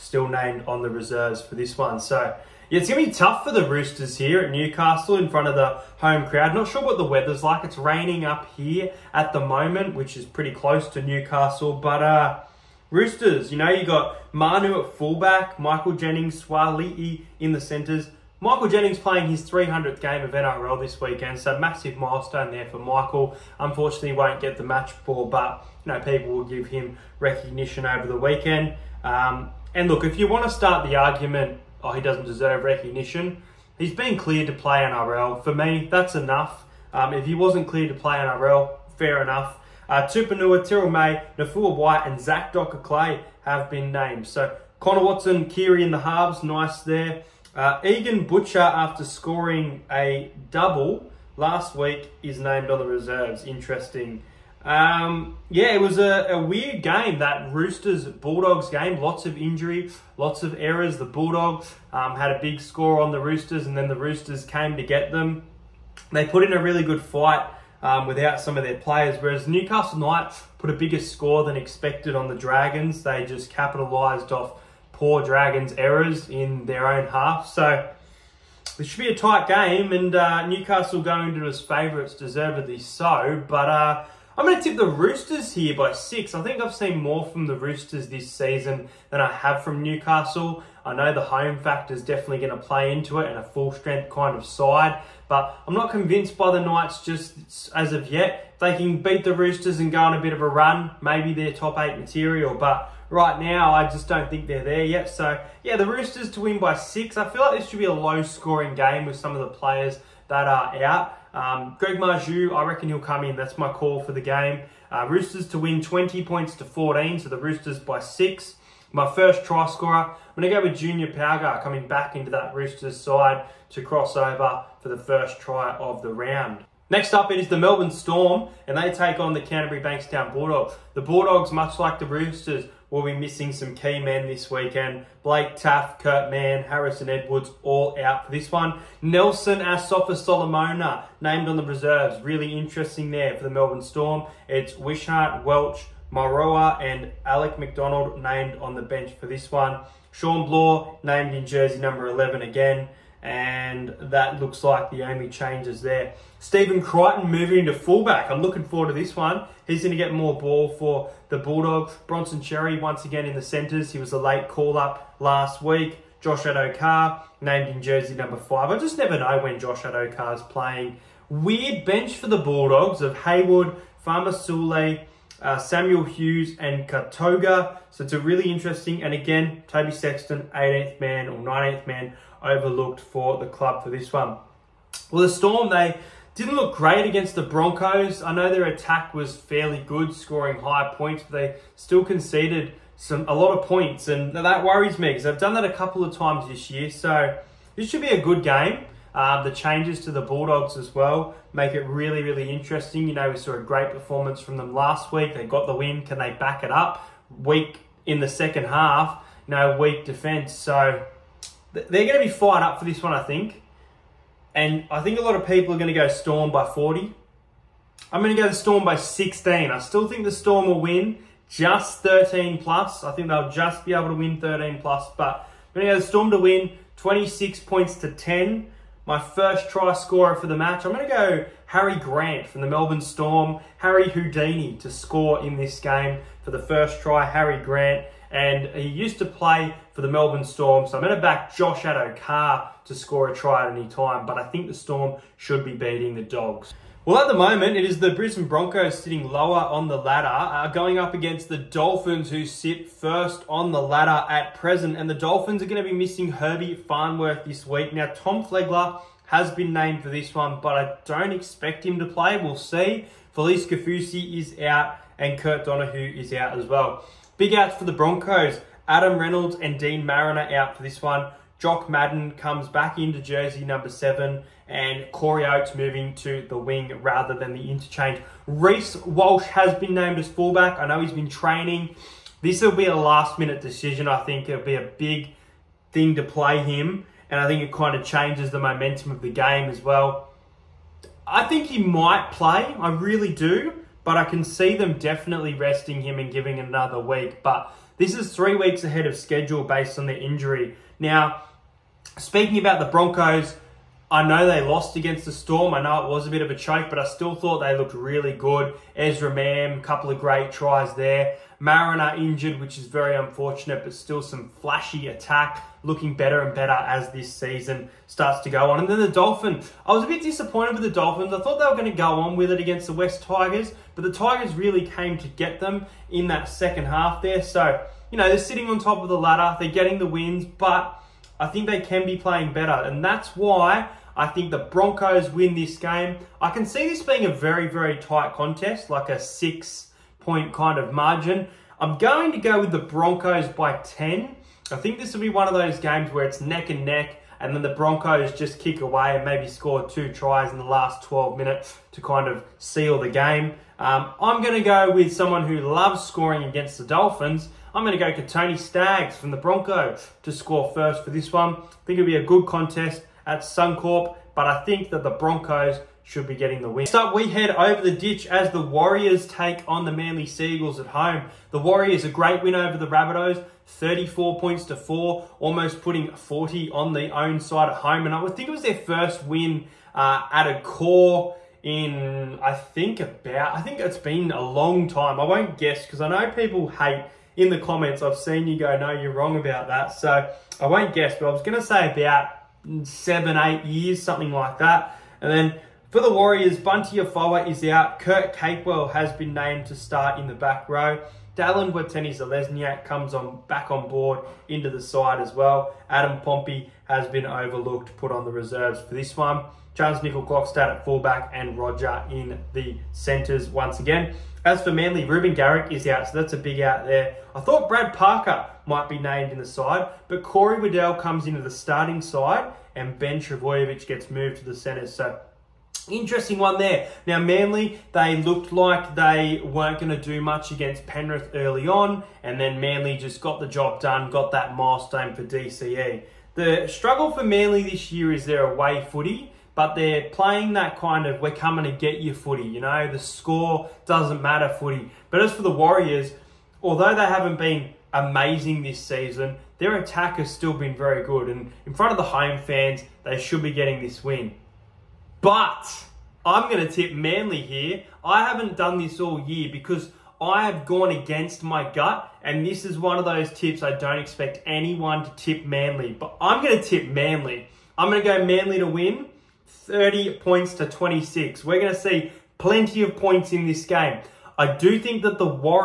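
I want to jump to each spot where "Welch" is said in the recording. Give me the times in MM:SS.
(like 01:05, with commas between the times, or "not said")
02:25.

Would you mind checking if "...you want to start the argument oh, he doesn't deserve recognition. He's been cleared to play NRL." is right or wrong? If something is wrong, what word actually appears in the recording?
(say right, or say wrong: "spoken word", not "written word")
right.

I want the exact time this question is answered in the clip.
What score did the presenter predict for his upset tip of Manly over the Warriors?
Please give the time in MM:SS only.
07:49.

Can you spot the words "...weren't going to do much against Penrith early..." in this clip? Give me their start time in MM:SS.
07:09.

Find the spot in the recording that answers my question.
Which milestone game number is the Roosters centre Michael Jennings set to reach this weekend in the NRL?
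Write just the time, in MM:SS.
00:19.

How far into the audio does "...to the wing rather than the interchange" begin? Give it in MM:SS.
04:36.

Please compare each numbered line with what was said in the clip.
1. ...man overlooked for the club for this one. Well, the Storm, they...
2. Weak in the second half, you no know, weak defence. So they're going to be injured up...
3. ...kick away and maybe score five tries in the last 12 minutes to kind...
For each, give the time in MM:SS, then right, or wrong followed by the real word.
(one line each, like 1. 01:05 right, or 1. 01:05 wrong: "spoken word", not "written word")
1. 03:01 right
2. 03:27 wrong: "fired", not "injured"
3. 05:48 wrong: "two", not "five".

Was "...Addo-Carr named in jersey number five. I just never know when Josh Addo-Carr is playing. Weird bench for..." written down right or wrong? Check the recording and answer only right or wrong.
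right.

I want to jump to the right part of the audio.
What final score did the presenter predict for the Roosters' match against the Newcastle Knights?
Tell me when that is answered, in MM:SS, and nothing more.
01:55.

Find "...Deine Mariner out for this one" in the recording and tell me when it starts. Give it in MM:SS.
04:29.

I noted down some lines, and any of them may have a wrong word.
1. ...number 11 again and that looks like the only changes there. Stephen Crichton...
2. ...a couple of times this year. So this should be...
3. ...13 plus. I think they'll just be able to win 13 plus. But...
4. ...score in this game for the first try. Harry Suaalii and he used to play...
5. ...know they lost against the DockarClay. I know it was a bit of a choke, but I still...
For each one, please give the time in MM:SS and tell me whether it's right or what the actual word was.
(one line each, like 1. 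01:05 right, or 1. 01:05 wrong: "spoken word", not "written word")
1. 02:31 right
2. 03:15 right
3. 03:42 right
4. 03:54 wrong: "Grant", not "Suaalii"
5. 05:04 wrong: "Storm", not "DockarClay".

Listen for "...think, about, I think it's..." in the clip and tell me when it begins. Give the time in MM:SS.
06:22.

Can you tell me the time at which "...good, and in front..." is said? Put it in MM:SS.
07:31.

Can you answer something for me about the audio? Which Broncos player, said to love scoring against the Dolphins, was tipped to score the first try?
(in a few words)
Tony Staggs.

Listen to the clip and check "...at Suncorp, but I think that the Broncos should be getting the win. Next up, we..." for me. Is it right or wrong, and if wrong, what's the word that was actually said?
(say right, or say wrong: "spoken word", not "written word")
right.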